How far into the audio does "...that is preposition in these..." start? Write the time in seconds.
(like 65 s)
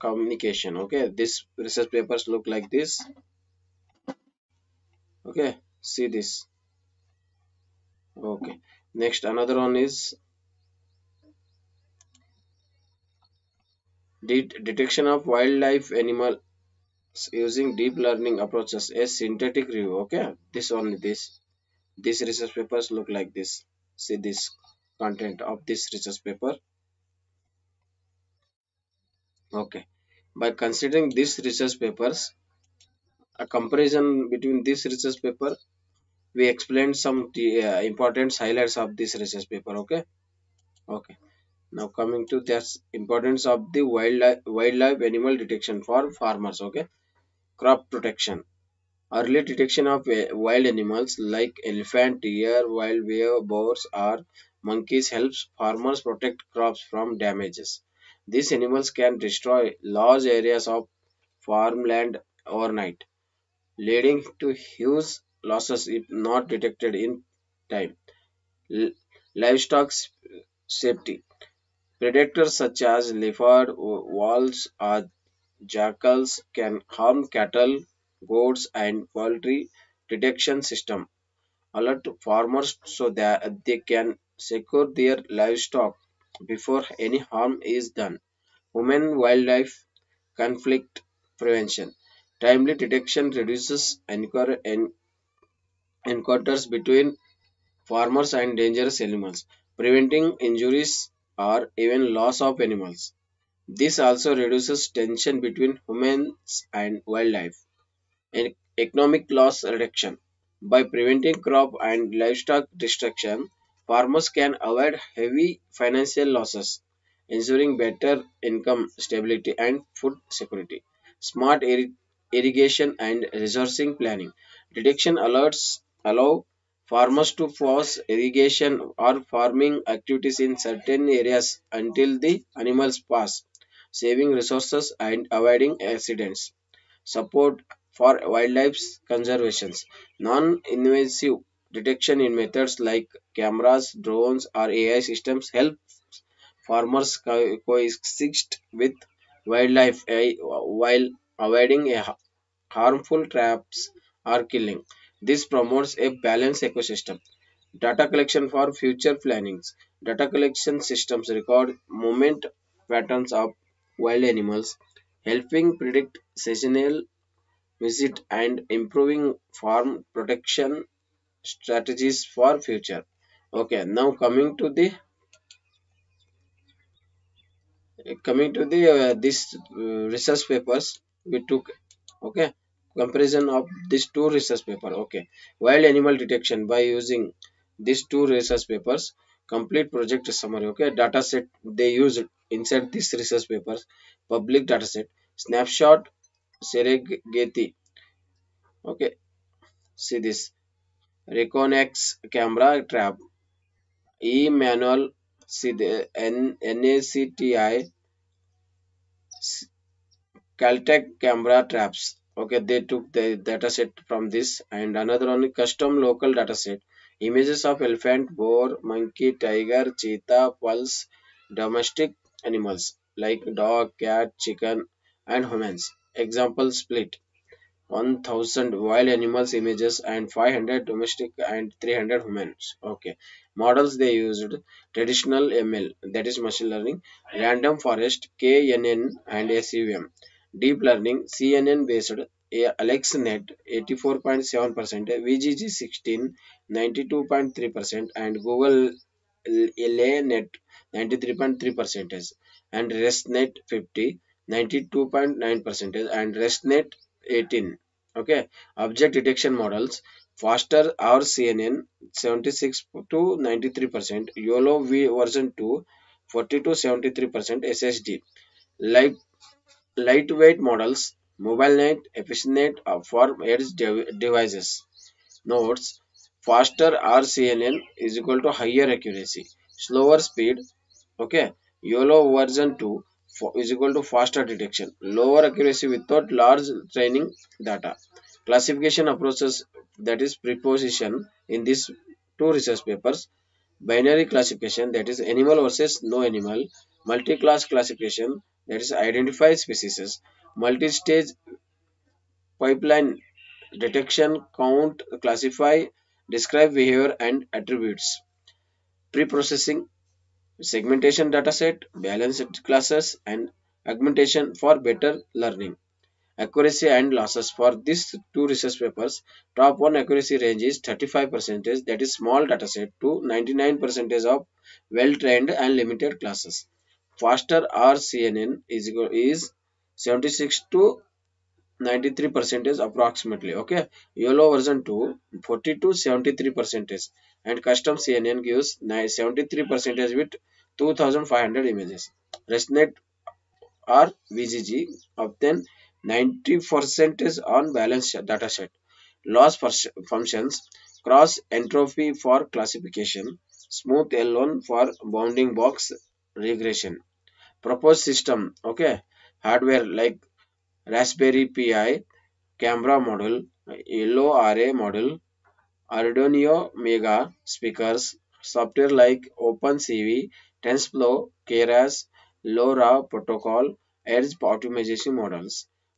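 289 s.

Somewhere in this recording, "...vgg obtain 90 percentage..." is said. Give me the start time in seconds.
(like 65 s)
344 s.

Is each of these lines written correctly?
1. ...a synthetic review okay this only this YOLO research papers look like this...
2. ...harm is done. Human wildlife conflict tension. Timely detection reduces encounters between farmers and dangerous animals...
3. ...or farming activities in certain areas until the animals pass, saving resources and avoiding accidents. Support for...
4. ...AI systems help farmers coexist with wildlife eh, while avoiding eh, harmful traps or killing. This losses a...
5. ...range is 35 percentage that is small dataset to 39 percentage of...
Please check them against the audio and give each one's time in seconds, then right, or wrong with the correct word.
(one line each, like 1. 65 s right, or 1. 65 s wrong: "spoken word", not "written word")
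1. 18 s wrong: "This", not "YOLO"
2. 87 s wrong: "prevention", not "tension"
3. 129 s right
4. 144 s wrong: "promotes", not "losses"
5. 320 s wrong: "99", not "39".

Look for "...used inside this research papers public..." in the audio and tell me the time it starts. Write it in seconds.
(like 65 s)
191 s.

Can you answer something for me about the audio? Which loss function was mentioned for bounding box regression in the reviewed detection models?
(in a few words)
Smooth L1.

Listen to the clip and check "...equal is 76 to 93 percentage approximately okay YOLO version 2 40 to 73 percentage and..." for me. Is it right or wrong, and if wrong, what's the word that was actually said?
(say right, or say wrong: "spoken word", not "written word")
right.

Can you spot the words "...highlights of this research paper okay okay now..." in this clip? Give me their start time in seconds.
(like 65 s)
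38 s.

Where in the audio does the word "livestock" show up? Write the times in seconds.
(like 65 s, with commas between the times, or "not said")
69 s, 85 s, 112 s.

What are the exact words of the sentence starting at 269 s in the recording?
lightweight models, mobile net, efficient uh, for edge devices.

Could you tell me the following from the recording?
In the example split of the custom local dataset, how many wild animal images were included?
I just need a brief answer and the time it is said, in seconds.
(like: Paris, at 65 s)
1000, at 227 s.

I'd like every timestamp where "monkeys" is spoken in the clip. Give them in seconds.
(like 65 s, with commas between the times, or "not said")
54 s, 218 s.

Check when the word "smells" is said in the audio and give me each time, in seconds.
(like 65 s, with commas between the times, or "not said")
not said.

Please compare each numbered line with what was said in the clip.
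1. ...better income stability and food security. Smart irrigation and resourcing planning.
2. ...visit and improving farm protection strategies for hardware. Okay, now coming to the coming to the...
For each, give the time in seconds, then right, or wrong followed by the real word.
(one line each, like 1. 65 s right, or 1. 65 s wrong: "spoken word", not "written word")
1. 117 s right
2. 167 s wrong: "future", not "hardware".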